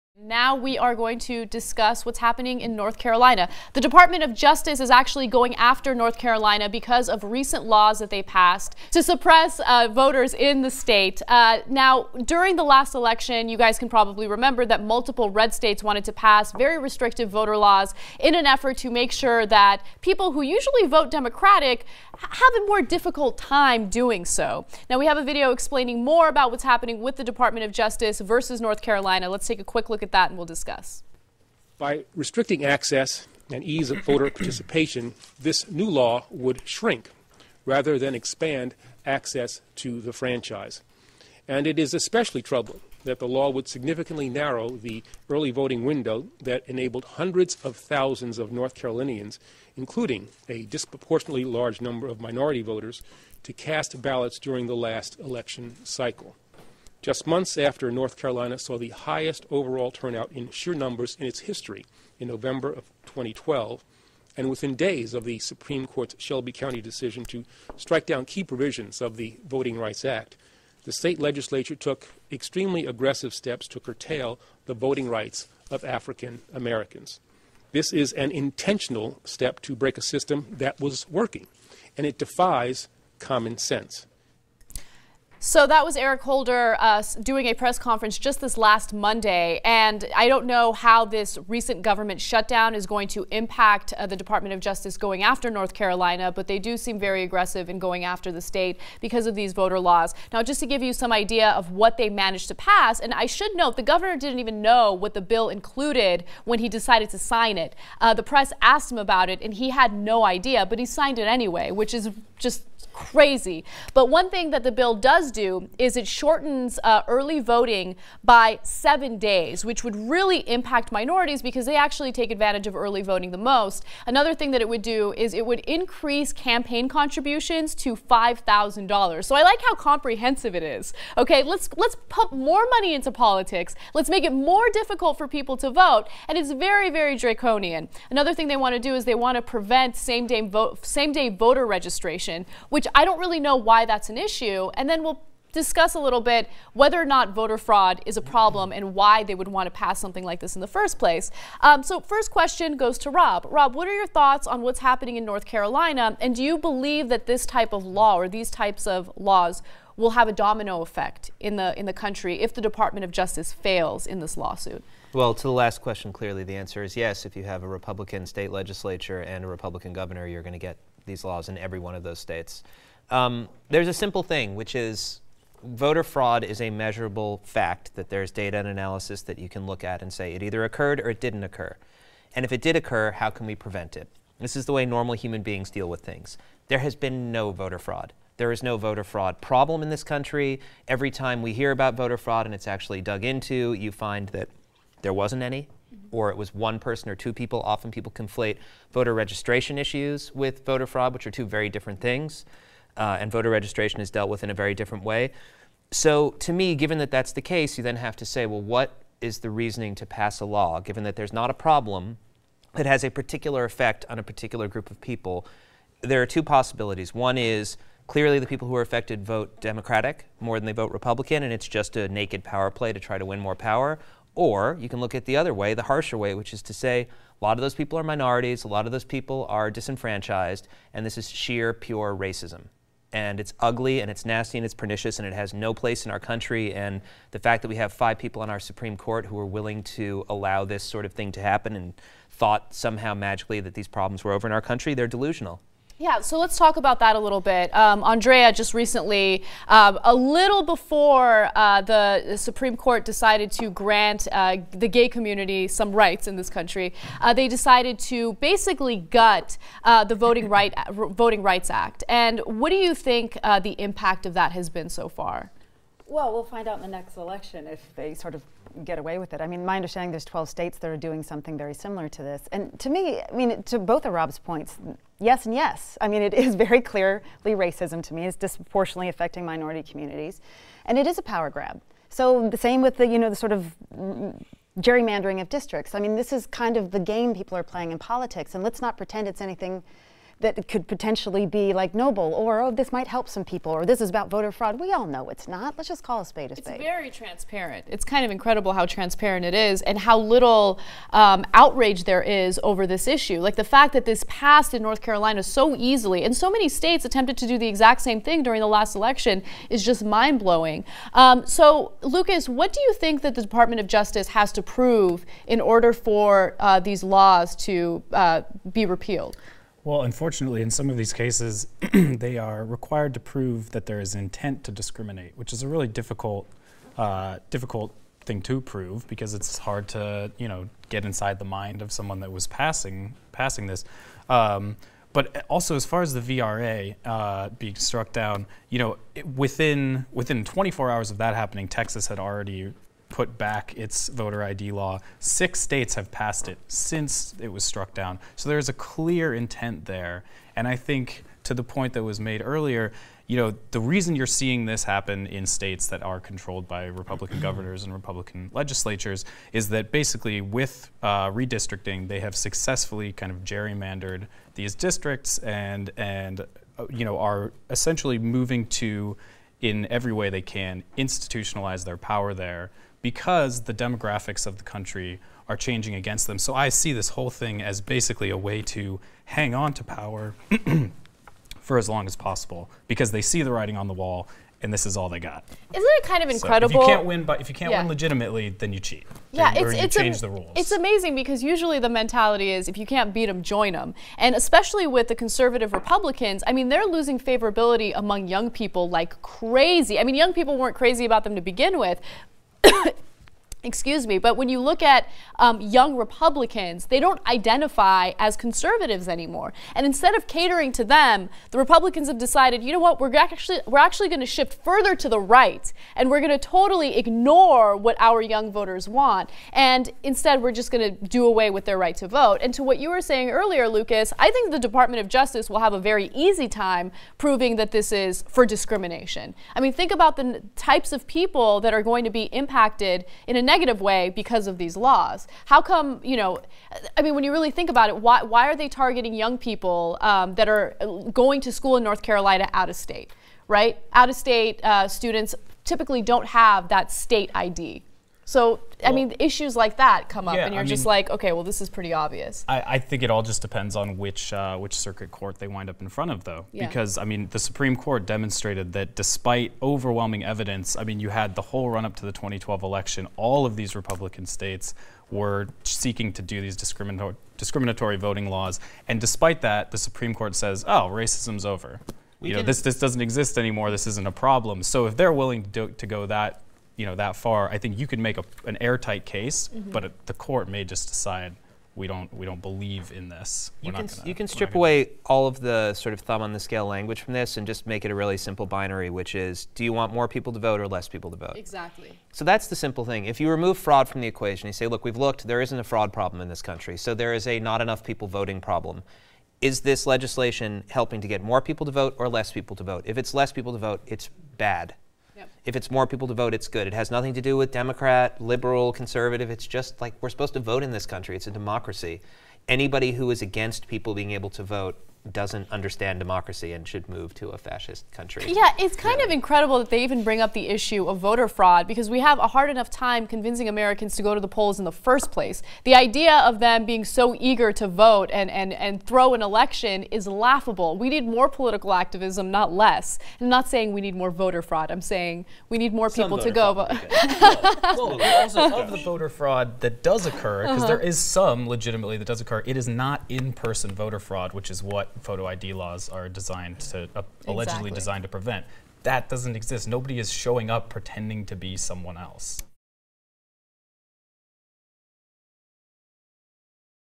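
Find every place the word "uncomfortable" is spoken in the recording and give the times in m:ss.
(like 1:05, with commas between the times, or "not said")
not said.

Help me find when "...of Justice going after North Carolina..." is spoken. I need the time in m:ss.
1:34.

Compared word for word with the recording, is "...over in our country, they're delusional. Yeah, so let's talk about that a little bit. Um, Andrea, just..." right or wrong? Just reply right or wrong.
right.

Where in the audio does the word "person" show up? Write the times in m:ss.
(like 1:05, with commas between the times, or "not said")
3:16, 9:03.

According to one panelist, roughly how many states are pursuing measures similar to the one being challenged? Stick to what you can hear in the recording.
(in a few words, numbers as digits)
12.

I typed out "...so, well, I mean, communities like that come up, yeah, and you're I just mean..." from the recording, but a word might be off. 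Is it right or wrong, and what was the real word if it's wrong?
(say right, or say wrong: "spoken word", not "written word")
wrong: "issues", not "communities".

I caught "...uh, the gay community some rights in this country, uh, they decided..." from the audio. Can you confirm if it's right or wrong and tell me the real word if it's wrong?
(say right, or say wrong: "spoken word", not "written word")
right.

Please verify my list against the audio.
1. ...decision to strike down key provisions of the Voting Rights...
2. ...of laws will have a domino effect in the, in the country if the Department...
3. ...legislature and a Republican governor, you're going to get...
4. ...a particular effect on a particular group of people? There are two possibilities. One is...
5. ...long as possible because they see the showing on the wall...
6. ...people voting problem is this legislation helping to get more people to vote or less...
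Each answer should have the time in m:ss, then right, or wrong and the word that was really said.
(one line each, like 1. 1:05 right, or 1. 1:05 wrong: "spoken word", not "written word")
1. 1:06 right
2. 2:38 right
3. 2:48 right
4. 3:33 right
5. 6:21 wrong: "writing", not "showing"
6. 8:17 right.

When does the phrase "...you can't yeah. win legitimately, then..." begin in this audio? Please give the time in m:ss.
6:27.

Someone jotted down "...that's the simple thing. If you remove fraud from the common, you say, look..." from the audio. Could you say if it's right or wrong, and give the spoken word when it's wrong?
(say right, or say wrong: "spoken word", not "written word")
wrong: "equation", not "common".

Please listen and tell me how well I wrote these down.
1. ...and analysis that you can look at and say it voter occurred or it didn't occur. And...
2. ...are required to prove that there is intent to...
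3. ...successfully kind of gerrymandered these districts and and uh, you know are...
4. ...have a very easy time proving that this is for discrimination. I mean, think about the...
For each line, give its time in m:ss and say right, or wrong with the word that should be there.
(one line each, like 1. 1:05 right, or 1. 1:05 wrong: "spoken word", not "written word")
1. 2:58 wrong: "either", not "voter"
2. 5:22 right
3. 6:02 right
4. 7:05 right.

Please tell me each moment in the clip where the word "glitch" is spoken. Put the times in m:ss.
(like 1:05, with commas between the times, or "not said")
not said.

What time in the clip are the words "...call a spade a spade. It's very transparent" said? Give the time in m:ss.
4:56.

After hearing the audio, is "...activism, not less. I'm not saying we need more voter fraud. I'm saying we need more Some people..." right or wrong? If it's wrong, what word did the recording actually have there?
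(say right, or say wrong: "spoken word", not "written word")
right.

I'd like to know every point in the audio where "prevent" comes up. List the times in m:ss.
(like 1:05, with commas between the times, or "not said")
2:19, 3:03, 9:08.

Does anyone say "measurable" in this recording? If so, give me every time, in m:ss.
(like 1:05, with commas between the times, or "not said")
2:56.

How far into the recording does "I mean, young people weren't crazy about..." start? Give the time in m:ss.
6:39.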